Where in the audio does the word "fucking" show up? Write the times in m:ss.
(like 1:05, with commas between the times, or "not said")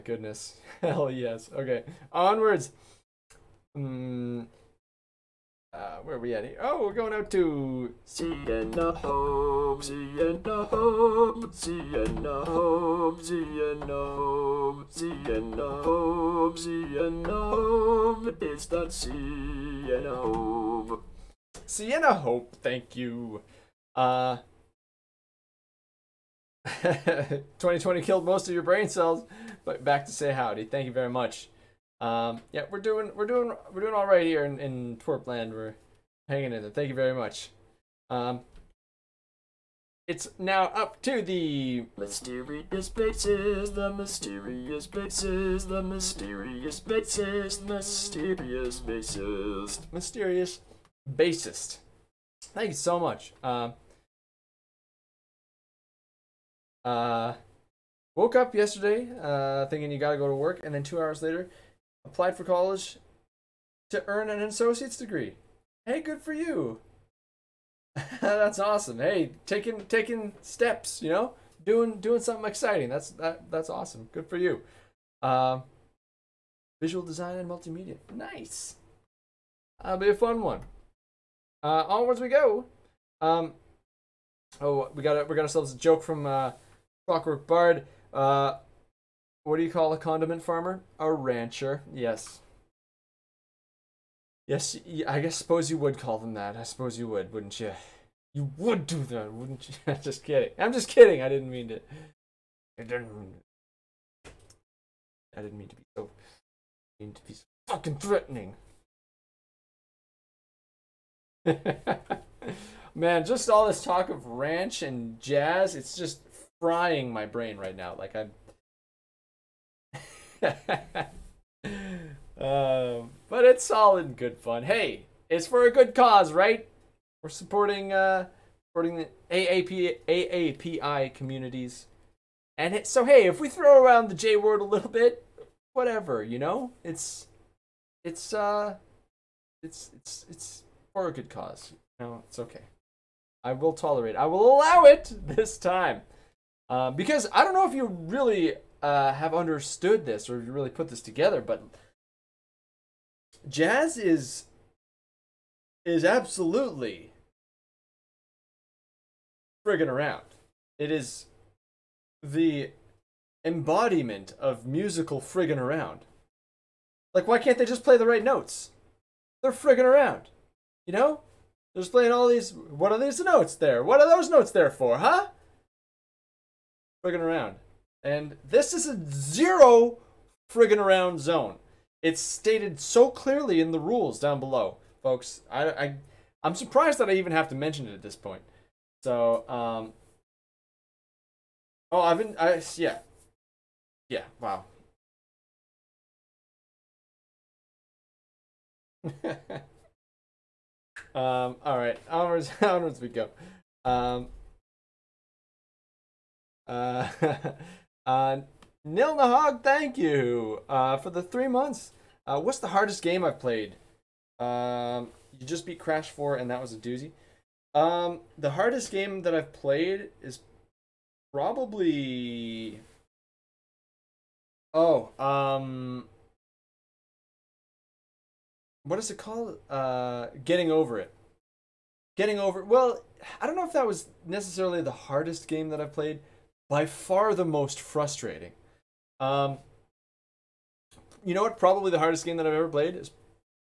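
1:47.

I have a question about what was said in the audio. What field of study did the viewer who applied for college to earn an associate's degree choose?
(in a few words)
Visual design and multimedia.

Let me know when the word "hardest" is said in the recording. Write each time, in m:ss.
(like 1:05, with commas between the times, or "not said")
3:32, 3:38, 3:54, 4:01.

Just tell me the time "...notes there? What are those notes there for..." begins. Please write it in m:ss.
2:53.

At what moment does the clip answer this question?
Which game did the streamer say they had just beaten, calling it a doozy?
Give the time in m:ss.
3:35.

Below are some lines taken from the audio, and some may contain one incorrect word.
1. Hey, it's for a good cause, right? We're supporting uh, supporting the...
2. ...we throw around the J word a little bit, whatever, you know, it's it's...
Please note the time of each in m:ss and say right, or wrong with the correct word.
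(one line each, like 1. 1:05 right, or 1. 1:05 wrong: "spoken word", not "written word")
1. 2:04 right
2. 2:13 right.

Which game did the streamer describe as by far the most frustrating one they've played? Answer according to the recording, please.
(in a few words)
Getting Over It.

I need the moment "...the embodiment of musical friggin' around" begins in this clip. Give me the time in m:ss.
2:42.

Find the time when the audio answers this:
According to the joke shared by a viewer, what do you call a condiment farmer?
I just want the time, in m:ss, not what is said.
1:30.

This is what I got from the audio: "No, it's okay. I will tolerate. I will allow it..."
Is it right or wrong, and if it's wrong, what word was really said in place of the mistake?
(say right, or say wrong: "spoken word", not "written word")
right.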